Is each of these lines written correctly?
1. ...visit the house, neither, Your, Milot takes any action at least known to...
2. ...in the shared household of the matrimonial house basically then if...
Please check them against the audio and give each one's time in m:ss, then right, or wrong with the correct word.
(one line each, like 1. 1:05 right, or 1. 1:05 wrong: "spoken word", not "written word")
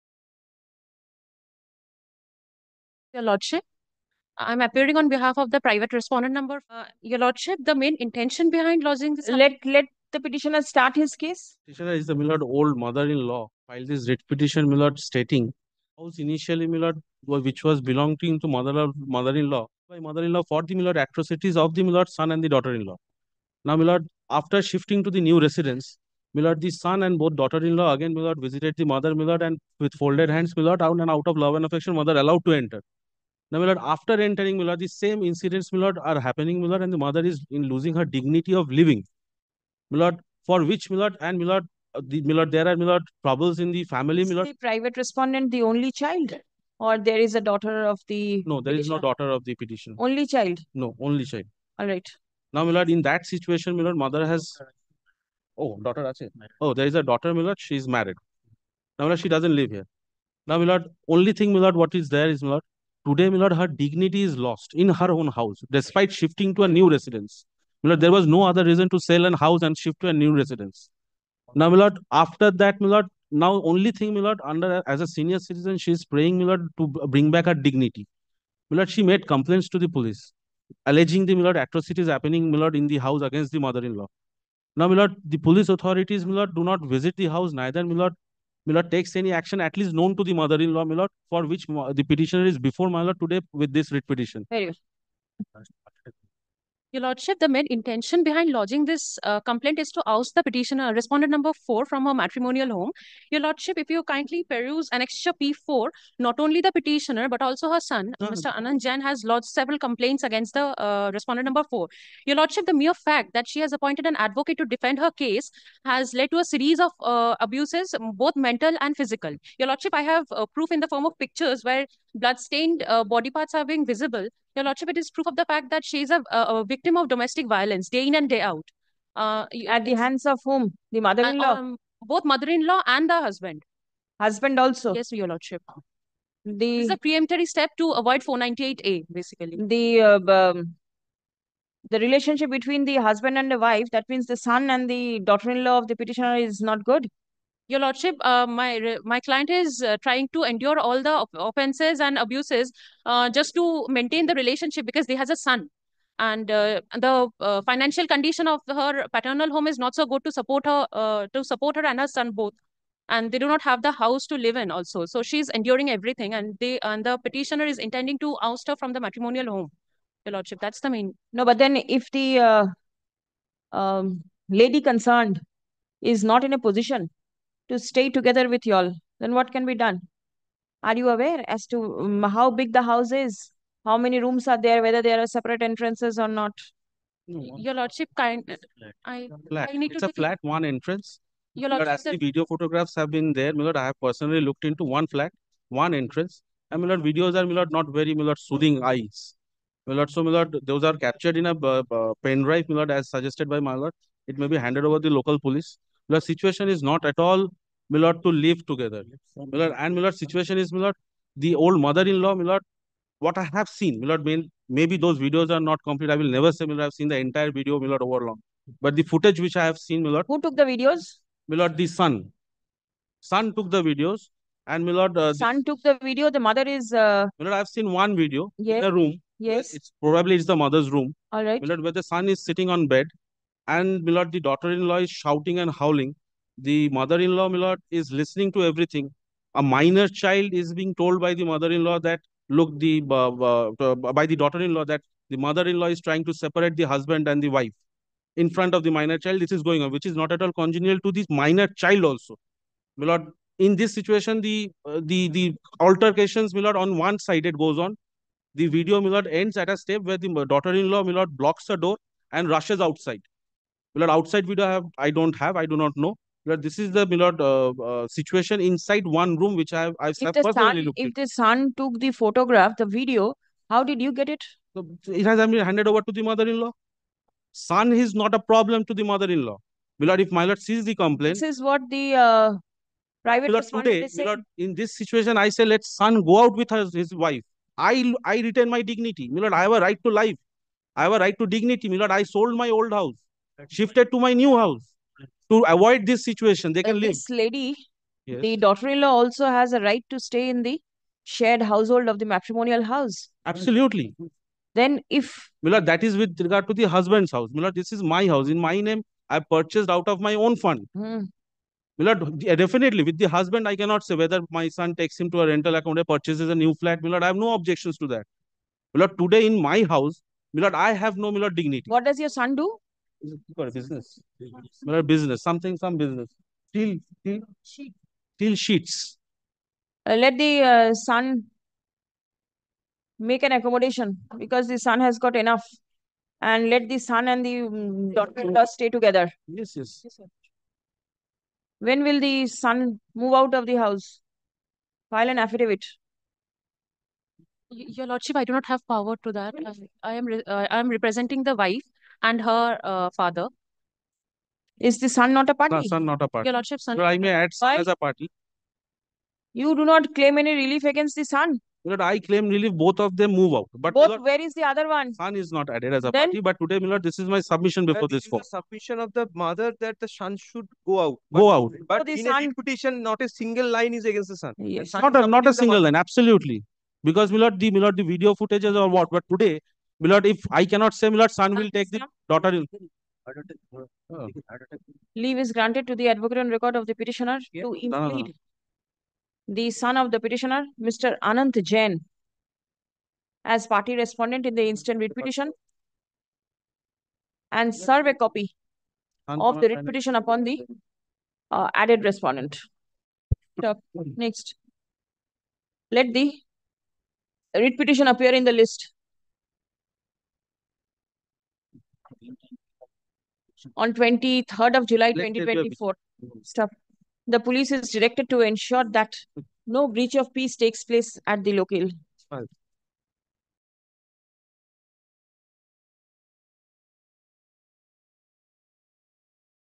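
1. 1:26 wrong: "Milord", not "Your"
2. 5:00 wrong: "absolutely", not "basically".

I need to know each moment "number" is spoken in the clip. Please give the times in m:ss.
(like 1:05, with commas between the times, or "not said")
0:06, 1:41, 1:51.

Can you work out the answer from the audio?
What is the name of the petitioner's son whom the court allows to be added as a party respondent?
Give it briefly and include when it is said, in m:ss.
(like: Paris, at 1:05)
Anant Jain, at 6:31.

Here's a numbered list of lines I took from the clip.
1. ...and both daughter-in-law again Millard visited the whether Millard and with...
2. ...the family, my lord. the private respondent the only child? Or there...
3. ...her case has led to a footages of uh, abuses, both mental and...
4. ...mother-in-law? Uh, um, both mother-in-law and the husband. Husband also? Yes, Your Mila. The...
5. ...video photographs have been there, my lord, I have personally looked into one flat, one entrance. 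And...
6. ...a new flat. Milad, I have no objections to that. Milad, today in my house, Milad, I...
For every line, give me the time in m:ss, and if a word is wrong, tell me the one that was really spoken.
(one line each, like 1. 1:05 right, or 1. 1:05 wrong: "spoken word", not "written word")
1. 0:27 wrong: "mother", not "whether"
2. 0:43 right
3. 1:54 wrong: "series", not "footages"
4. 2:10 wrong: "Lordship", not "Mila"
5. 3:12 right
6. 5:16 right.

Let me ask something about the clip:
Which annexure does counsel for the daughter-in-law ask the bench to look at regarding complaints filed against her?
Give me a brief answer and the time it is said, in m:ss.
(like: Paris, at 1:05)
Annexure P4, at 1:44.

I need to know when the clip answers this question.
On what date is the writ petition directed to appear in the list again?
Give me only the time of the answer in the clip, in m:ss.
6:53.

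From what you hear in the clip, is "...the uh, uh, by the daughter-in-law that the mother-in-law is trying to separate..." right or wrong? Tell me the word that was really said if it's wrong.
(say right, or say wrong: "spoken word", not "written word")
right.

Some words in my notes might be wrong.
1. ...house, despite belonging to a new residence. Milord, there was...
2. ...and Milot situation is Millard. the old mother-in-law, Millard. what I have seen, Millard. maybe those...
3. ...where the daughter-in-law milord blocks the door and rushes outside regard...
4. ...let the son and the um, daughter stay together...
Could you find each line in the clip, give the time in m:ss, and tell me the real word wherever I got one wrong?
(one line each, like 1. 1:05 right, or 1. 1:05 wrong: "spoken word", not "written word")
1. 1:05 wrong: "shifting", not "belonging"
2. 3:29 right
3. 4:20 wrong: "milord", not "regard"
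4. 5:36 right.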